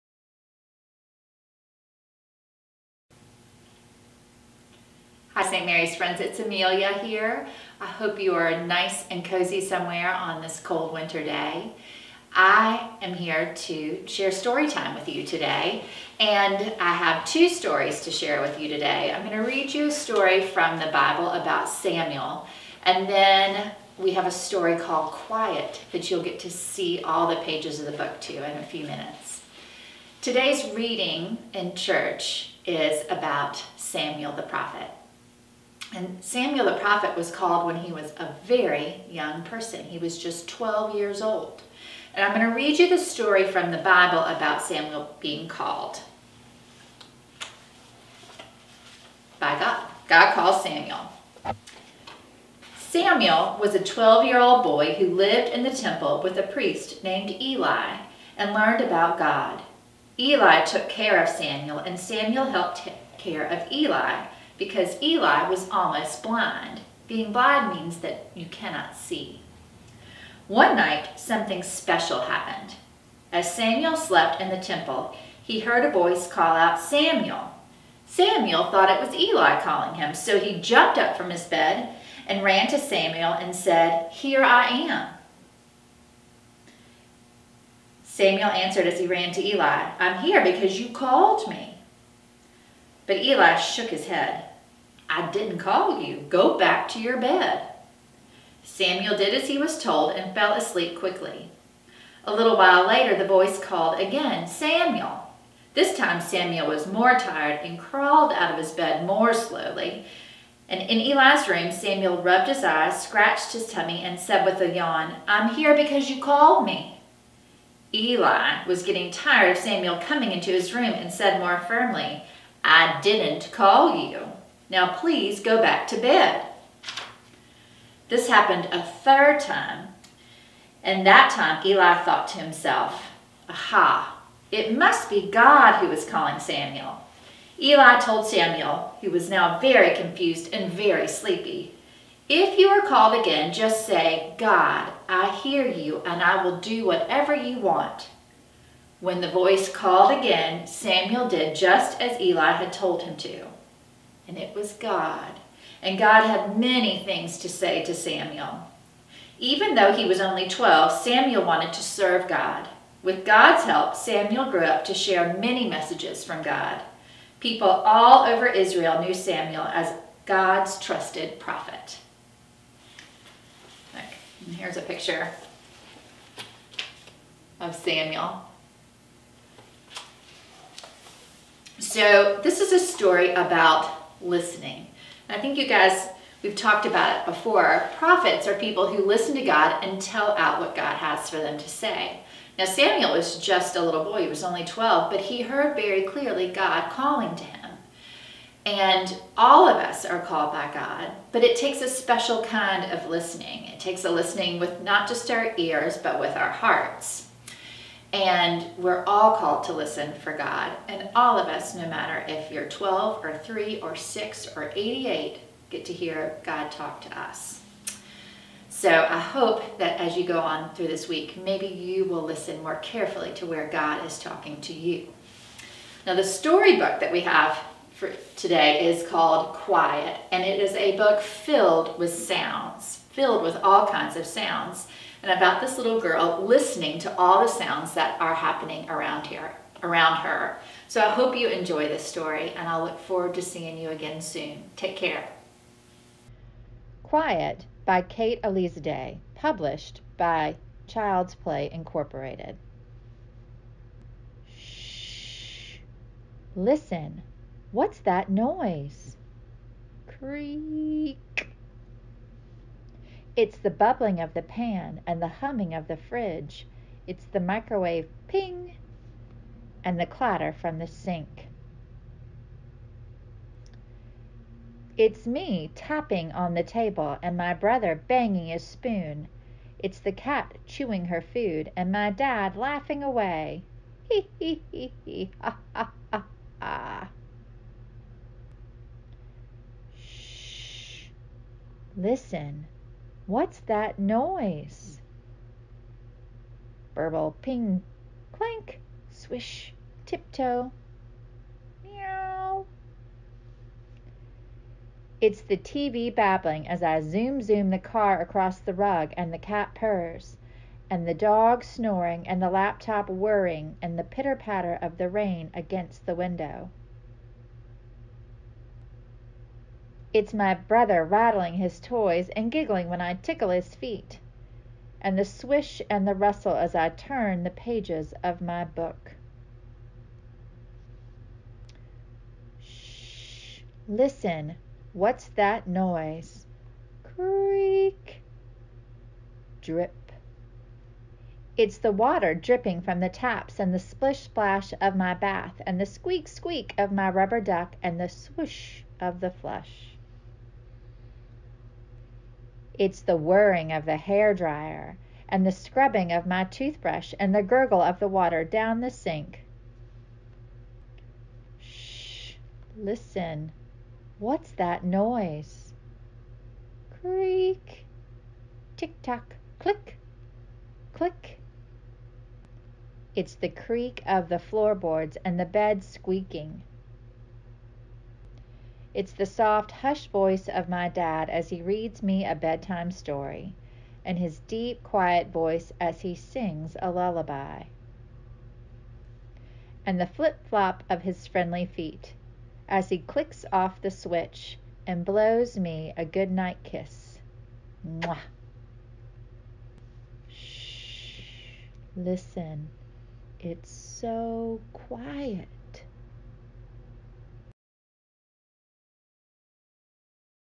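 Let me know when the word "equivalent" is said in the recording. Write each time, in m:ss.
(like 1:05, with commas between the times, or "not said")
not said.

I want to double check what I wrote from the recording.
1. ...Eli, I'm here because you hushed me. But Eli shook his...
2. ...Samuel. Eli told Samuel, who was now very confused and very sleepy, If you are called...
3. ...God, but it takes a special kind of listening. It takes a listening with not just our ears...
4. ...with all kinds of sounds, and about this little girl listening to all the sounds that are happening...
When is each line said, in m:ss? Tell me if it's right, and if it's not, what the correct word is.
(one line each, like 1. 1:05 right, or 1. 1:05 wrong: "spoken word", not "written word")
1. 1:29 wrong: "called", not "hushed"
2. 2:16 right
3. 3:20 right
4. 3:53 right.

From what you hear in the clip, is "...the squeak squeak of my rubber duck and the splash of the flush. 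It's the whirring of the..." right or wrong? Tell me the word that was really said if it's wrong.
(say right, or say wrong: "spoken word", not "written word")
wrong: "swoosh", not "splash".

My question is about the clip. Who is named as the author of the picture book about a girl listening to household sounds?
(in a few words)
Kate Day.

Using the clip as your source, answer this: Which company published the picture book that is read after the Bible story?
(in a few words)
Child's Play Incorporated.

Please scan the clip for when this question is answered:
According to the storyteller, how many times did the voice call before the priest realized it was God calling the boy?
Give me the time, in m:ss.
2:08.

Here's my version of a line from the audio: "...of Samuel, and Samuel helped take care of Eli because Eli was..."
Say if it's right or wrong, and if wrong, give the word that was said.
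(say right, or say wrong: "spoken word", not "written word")
right.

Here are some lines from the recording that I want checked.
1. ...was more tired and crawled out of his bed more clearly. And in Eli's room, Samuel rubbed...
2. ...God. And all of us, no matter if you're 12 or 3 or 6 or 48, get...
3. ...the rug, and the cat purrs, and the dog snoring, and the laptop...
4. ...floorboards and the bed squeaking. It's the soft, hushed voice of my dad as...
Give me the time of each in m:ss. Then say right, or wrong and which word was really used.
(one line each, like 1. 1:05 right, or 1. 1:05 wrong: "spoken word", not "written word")
1. 1:46 wrong: "slowly", not "clearly"
2. 3:30 wrong: "88", not "48"
3. 5:08 right
4. 6:14 right.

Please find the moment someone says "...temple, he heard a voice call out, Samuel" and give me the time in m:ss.
1:14.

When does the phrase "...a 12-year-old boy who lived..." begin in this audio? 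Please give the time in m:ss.
0:53.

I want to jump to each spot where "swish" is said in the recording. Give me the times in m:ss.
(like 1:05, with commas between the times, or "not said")
4:59, 5:25.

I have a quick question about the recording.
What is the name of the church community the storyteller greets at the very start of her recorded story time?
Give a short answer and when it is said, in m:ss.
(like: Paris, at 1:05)
St. Mary's, at 0:05.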